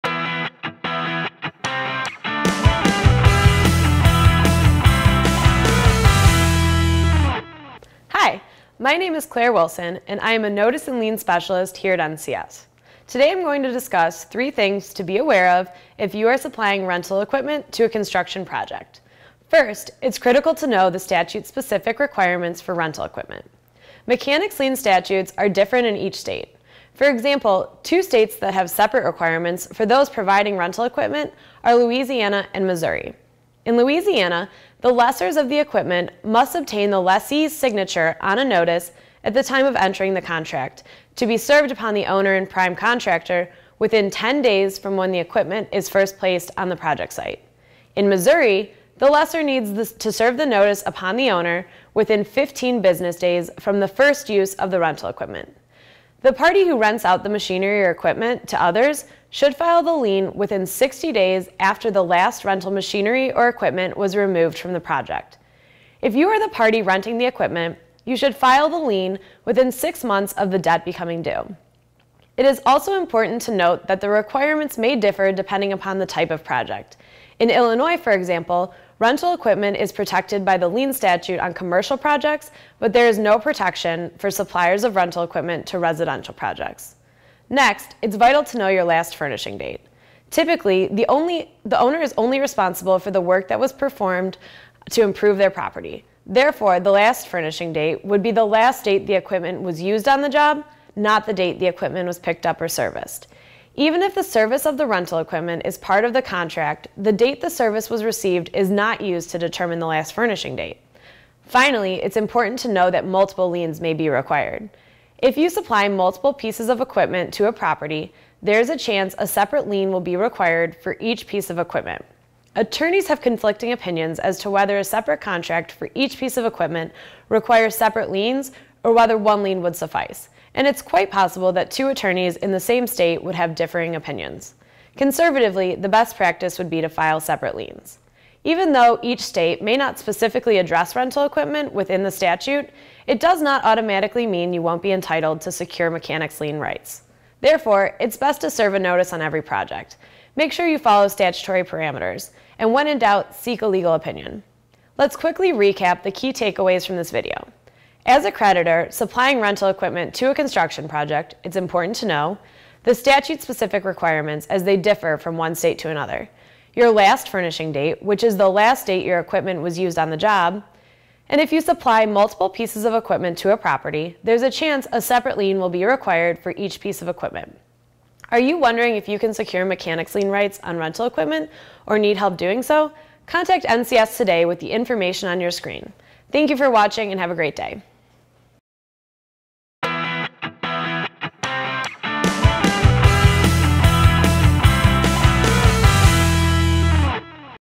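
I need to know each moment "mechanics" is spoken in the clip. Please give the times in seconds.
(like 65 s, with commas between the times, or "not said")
24 s, 145 s, 179 s.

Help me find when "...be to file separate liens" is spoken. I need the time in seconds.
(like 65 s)
136 s.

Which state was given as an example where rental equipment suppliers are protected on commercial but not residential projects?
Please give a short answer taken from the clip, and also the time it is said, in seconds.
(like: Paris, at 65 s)
Illinois, at 77 s.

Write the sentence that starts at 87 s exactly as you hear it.
Next, it's vital to know your last furnishing date.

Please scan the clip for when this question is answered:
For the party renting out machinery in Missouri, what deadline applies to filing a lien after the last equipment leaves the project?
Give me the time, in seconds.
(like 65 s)
60 s.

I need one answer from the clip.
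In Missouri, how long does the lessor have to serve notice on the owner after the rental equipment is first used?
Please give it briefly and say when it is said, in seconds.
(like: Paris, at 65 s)
15 business days, at 52 s.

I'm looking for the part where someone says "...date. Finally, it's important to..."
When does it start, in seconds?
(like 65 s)
110 s.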